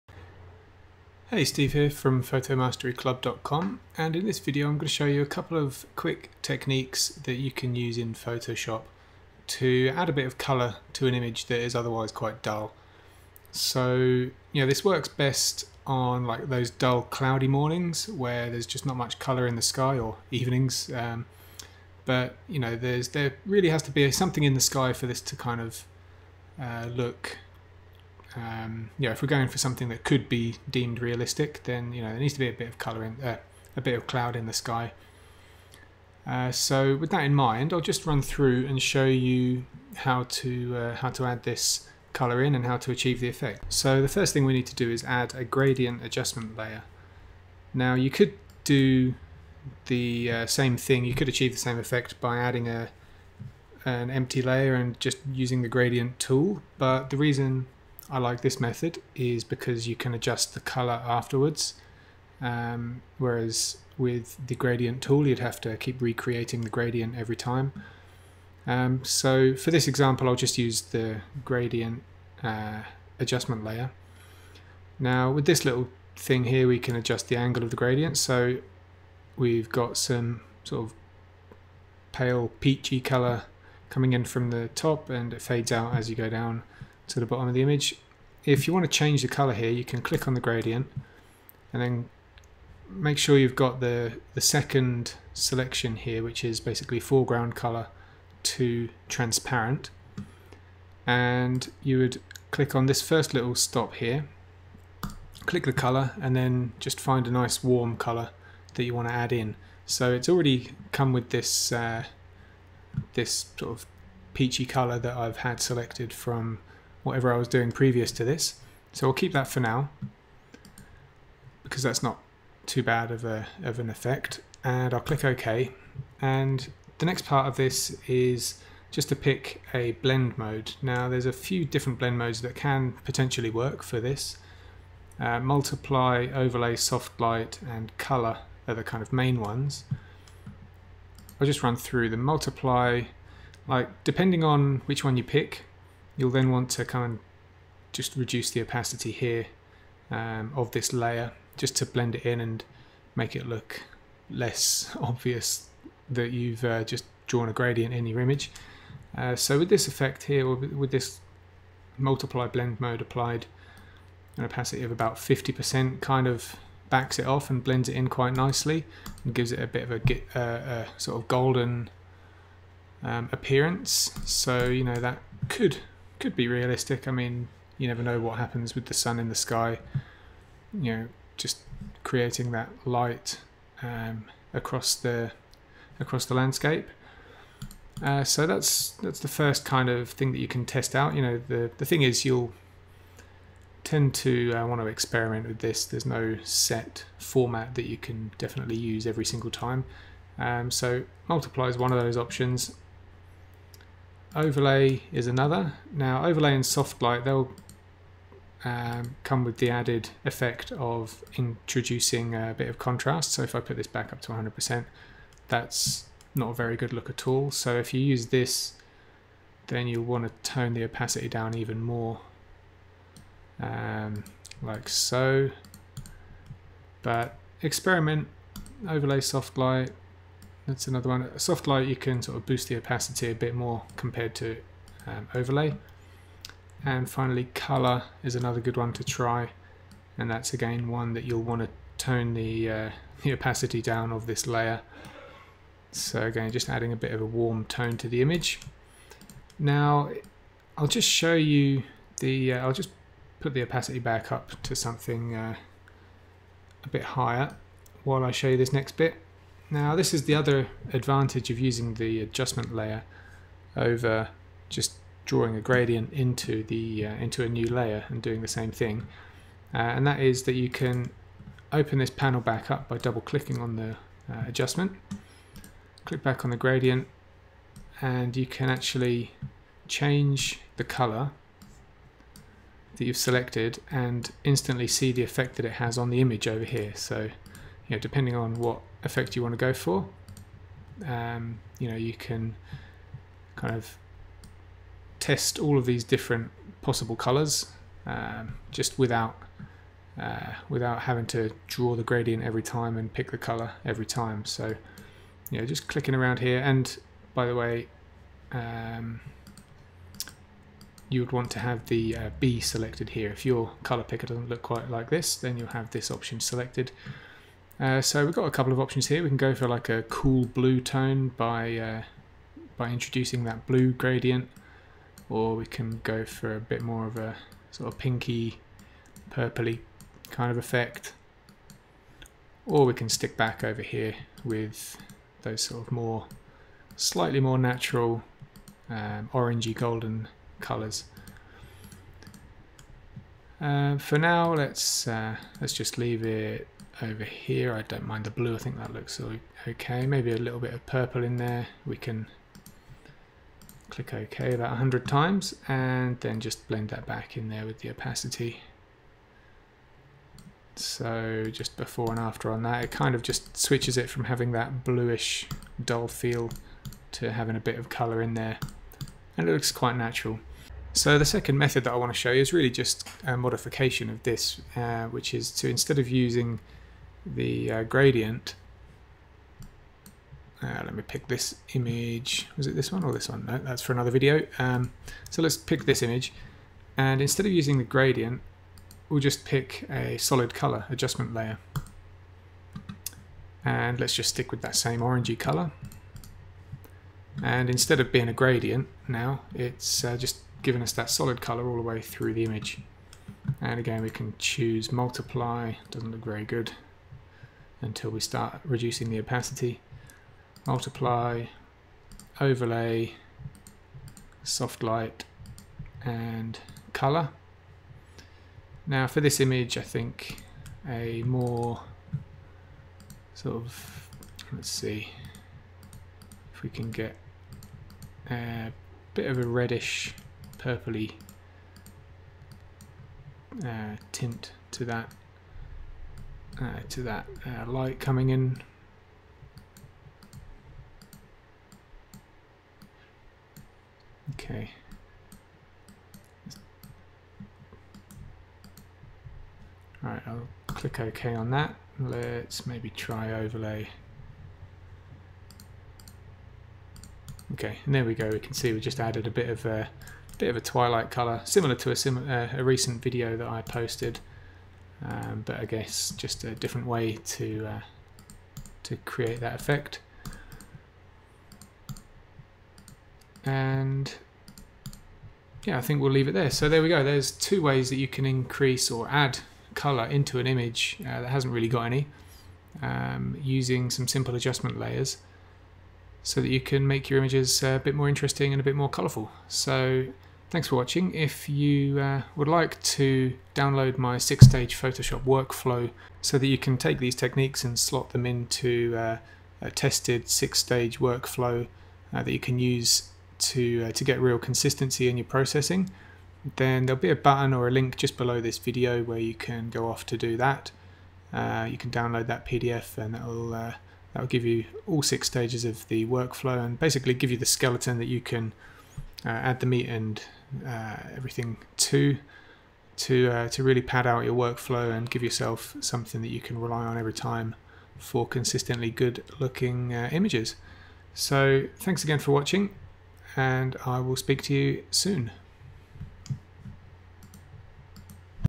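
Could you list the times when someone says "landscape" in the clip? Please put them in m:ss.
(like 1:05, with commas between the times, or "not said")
3:06.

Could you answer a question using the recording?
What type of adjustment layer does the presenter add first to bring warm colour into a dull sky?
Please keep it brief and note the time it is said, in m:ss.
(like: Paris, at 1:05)
gradient adjustment layer, at 0:45.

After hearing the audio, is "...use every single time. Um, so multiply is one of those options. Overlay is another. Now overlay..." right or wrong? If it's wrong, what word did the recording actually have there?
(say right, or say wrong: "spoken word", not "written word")
right.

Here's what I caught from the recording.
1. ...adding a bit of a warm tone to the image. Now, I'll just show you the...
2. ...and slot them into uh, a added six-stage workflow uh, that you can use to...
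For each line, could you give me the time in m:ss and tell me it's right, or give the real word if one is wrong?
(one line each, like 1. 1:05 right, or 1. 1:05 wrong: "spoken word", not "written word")
1. 4:06 right
2. 8:17 wrong: "tested", not "added".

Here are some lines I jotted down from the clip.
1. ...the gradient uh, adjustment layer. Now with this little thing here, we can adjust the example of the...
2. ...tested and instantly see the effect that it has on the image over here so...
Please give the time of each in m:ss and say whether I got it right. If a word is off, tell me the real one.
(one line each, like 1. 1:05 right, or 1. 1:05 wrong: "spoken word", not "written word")
1. 1:10 wrong: "angle", not "example"
2. 4:43 wrong: "selected", not "tested".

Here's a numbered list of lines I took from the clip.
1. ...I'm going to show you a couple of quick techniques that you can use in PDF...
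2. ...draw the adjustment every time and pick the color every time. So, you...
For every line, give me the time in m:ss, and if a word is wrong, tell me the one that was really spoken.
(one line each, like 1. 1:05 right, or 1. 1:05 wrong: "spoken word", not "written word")
1. 0:04 wrong: "Photoshop", not "PDF"
2. 5:01 wrong: "gradient", not "adjustment".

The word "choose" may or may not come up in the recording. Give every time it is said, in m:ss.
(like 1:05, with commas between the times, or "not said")
6:44.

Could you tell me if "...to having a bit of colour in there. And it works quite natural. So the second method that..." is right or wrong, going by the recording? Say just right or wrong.
wrong.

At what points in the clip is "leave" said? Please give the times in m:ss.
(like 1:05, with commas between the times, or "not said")
5:45, 7:56.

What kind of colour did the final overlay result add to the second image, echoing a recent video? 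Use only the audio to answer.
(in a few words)
twilight.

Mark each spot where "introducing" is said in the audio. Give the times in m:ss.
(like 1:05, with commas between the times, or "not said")
3:31, 5:22.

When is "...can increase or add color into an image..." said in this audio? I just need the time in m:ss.
7:58.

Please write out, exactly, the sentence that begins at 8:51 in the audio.
So thanks again for watching and I will speak to you soon.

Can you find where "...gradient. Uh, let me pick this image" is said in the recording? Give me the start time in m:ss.
6:17.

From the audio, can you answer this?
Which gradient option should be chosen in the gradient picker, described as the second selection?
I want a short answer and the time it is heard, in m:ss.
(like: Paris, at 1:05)
foreground color to transparent, at 1:36.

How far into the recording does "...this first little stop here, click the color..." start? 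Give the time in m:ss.
1:42.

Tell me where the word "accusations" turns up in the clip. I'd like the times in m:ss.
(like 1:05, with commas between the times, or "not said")
not said.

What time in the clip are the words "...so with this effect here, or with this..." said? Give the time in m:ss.
2:39.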